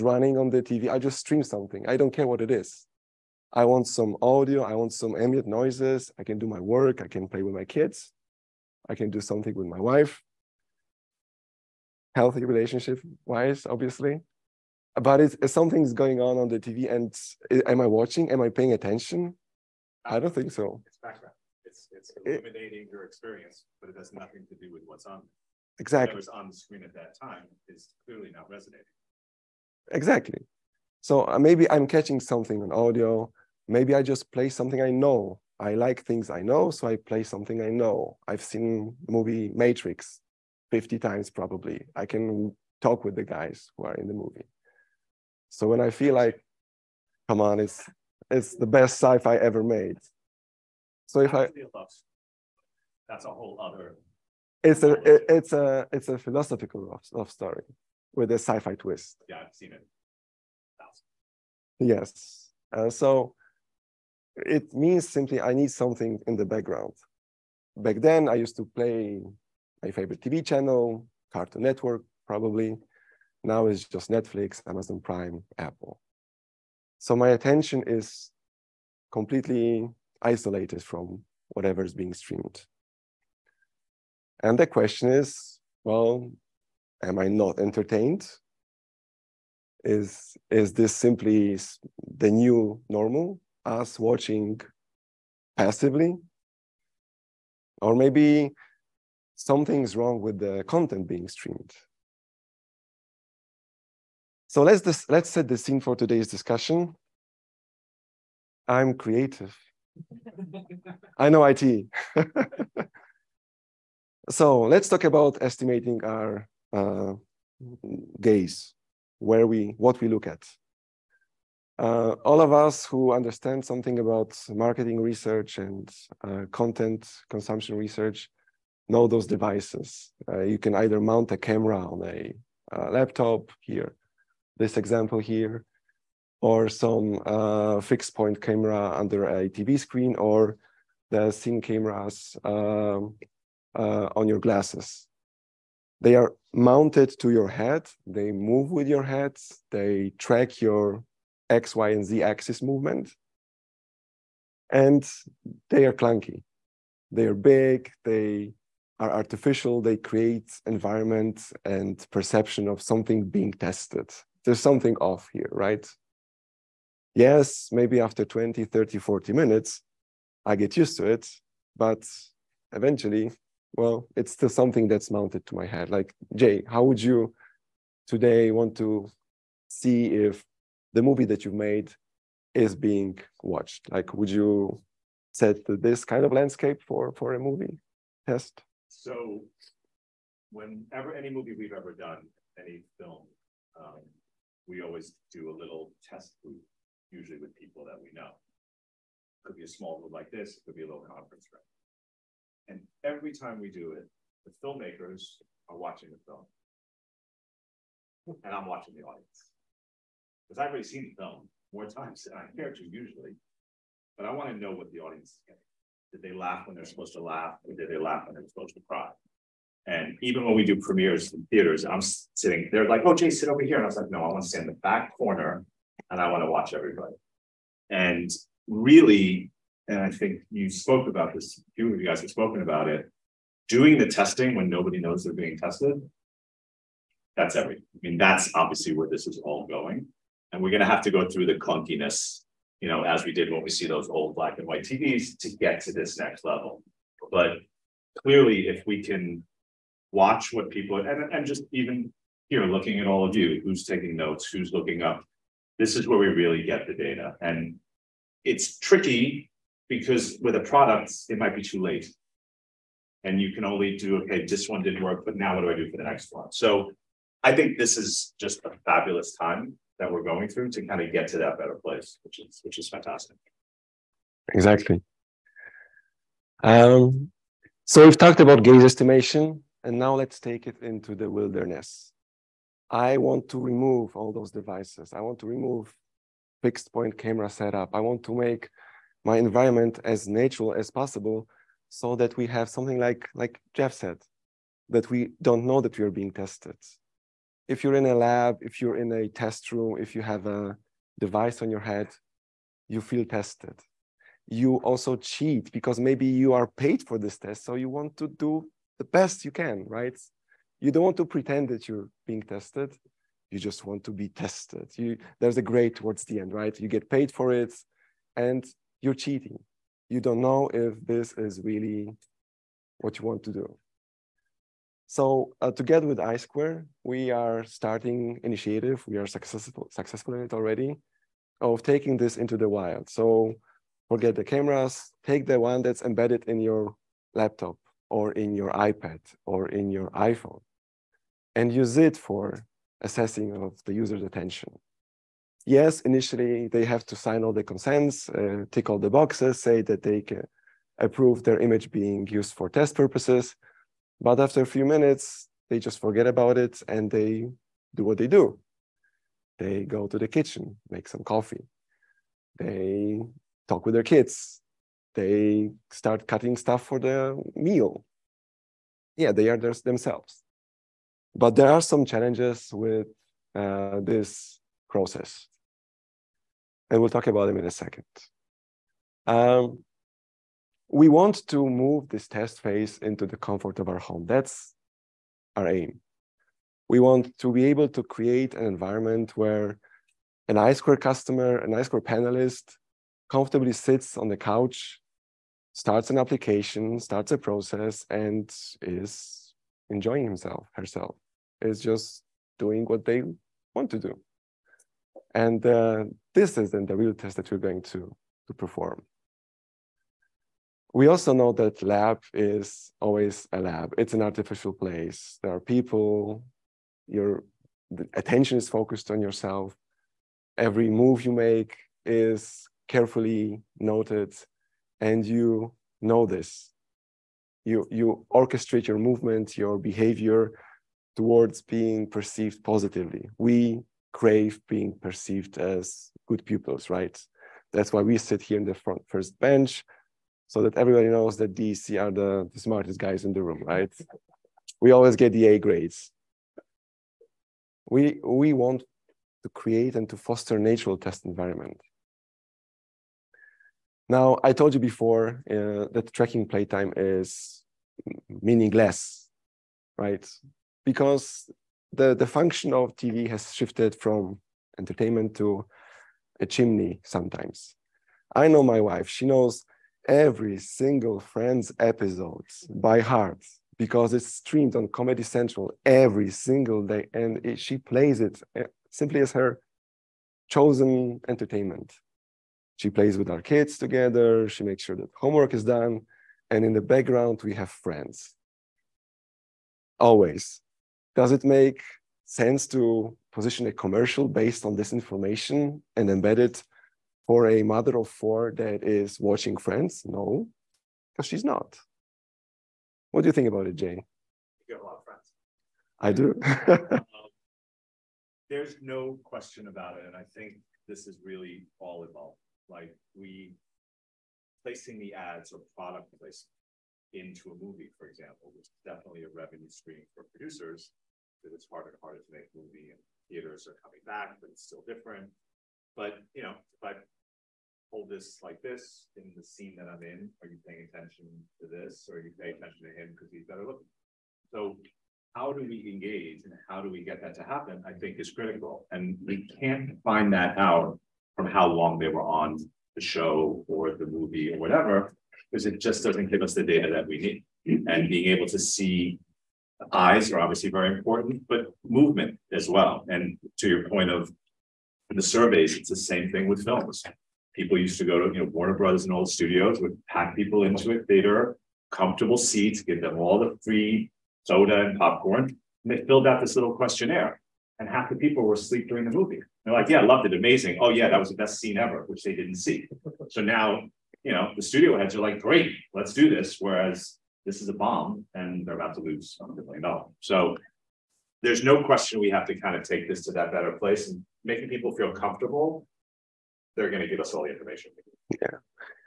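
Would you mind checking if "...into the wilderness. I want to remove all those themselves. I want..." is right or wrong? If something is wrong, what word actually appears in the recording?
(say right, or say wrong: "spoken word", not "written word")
wrong: "devices", not "themselves".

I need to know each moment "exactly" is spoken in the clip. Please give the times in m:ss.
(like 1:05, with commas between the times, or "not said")
0:25, 0:29, 4:34.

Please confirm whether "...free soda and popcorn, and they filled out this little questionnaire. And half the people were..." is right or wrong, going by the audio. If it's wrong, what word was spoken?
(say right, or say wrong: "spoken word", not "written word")
right.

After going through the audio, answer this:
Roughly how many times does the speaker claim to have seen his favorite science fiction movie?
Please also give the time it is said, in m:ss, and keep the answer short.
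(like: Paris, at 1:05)
50, at 0:40.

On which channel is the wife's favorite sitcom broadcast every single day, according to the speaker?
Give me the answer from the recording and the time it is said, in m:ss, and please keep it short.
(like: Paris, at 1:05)
Comedy Central, at 7:54.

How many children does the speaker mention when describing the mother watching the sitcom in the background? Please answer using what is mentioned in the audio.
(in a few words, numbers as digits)
4.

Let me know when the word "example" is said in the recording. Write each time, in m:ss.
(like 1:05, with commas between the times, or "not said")
2:14, 8:38.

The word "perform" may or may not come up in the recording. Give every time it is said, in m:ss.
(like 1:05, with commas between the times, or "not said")
6:48.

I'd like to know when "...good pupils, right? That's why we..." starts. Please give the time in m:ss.
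7:16.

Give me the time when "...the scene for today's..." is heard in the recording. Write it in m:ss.
1:45.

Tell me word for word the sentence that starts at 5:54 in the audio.
But after a few minutes, they just forget about it and they do what they do.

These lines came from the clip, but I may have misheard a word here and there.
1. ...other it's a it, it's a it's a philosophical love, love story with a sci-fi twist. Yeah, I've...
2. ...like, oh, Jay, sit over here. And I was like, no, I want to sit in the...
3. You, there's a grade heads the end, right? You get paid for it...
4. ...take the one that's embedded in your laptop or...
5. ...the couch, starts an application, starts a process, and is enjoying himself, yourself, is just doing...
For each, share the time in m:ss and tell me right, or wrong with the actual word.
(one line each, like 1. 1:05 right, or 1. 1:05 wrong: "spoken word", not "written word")
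1. 0:53 right
2. 3:42 right
3. 5:14 wrong: "towards", not "heads"
4. 5:35 right
5. 6:34 wrong: "herself", not "yourself".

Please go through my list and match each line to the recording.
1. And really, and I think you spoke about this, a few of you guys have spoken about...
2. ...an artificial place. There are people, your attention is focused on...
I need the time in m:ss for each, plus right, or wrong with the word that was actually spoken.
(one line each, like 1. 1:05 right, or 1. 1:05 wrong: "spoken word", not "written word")
1. 3:47 right
2. 6:54 right.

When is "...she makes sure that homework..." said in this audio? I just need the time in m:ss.
8:04.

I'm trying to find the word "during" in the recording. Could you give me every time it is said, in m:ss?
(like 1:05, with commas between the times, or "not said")
9:28.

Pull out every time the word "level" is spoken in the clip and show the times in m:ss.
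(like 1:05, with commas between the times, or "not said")
4:06.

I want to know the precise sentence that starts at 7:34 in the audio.
Now, I told you before uh, that tracking playtime is meaningless, right?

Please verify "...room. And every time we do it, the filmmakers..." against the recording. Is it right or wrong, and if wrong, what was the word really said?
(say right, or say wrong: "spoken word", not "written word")
right.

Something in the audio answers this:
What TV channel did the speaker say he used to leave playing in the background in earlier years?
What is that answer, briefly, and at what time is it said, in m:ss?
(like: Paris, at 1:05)
Cartoon Network, at 1:11.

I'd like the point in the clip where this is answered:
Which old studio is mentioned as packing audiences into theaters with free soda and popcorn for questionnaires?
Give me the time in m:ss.
9:18.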